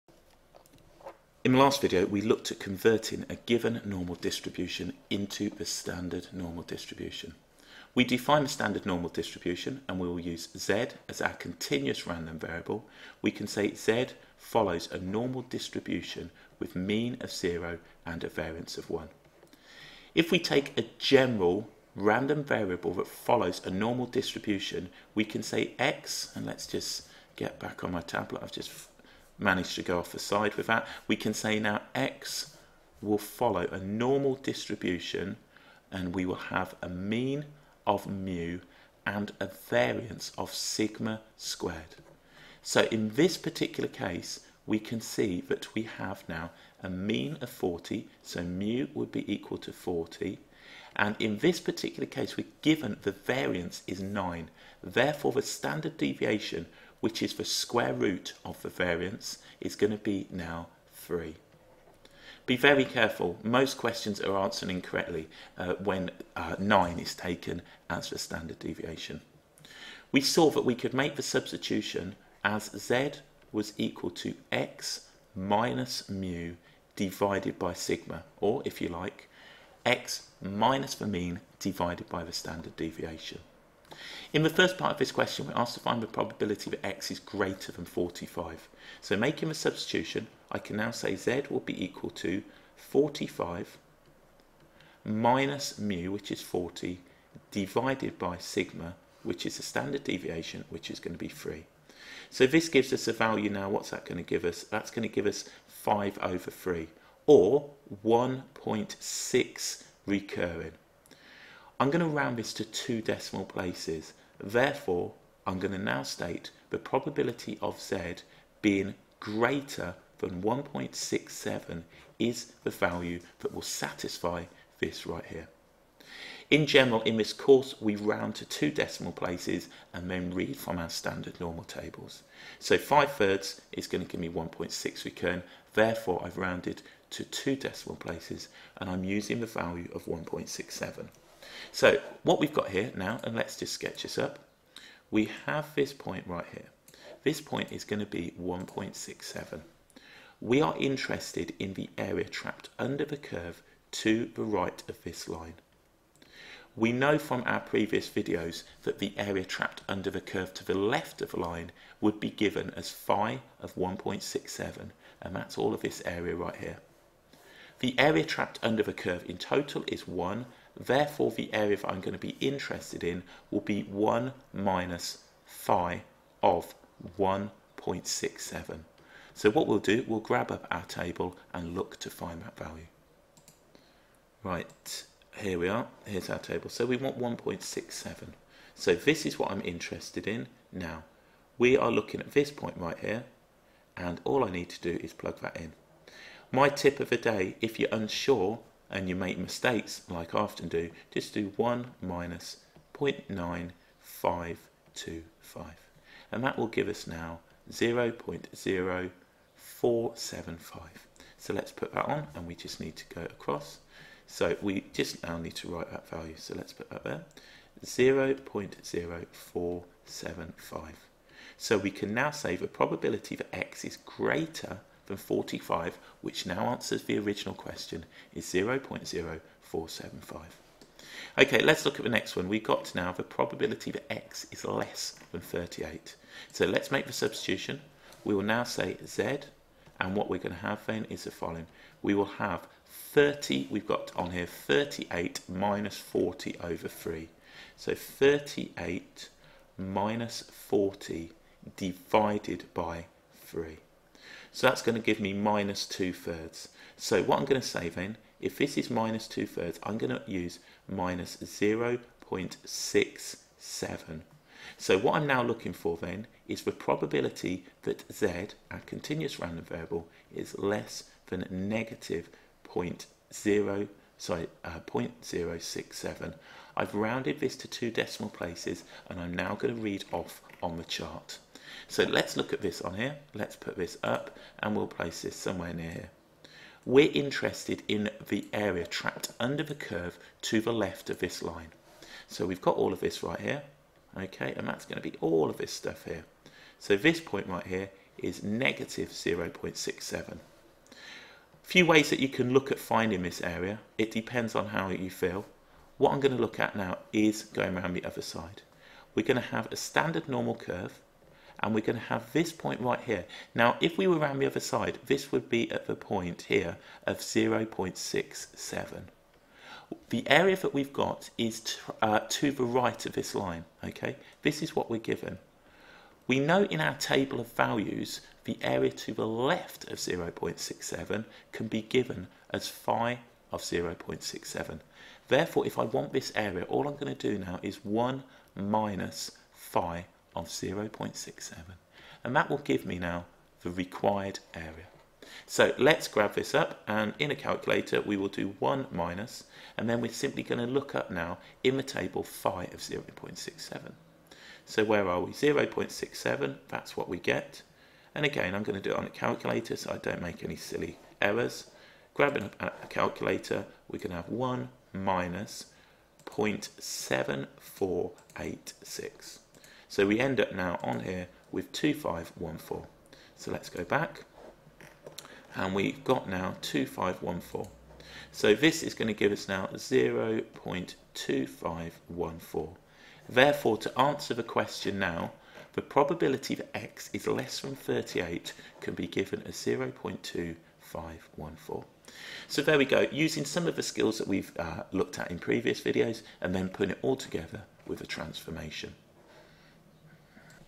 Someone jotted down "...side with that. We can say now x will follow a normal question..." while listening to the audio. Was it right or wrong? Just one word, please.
wrong.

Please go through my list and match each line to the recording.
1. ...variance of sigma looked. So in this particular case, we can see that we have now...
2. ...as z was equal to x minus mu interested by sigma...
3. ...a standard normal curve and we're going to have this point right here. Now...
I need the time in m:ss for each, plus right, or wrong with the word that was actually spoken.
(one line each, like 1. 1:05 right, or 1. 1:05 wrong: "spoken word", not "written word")
1. 0:39 wrong: "squared", not "looked"
2. 1:12 wrong: "divided", not "interested"
3. 5:09 right.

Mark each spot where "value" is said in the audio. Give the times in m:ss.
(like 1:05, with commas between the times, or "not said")
1:43, 2:02, 2:19, 3:02, 3:36, 5:27.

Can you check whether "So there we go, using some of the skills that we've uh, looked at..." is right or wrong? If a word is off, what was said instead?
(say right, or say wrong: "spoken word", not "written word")
right.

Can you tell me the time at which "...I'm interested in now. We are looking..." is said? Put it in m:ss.
3:09.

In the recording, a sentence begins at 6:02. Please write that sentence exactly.
Grabbing a calculator, we can have 1 minus 0.7486.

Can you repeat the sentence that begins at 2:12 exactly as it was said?
So 5 thirds is going to give me 1.6 recurring.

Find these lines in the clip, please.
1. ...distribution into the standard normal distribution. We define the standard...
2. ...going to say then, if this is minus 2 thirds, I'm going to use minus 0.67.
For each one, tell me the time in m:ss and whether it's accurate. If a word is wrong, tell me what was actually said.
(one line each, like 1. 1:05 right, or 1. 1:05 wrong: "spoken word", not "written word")
1. 0:04 right
2. 4:17 right.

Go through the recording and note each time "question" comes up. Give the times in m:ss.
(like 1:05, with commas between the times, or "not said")
1:03, 1:25, 3:47, 6:24.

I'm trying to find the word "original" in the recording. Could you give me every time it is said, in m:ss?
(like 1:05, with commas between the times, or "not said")
3:47.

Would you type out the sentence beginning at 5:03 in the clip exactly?
It depends on how you feel.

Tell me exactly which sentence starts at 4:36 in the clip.
I've rounded this to two decimal places and I'm now going to read off on the chart.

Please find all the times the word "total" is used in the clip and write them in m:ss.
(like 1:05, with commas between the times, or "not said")
2:49.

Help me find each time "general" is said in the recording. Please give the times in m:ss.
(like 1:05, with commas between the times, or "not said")
0:20, 2:06.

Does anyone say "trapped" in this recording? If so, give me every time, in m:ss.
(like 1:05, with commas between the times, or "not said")
2:32, 2:39, 2:48, 4:48.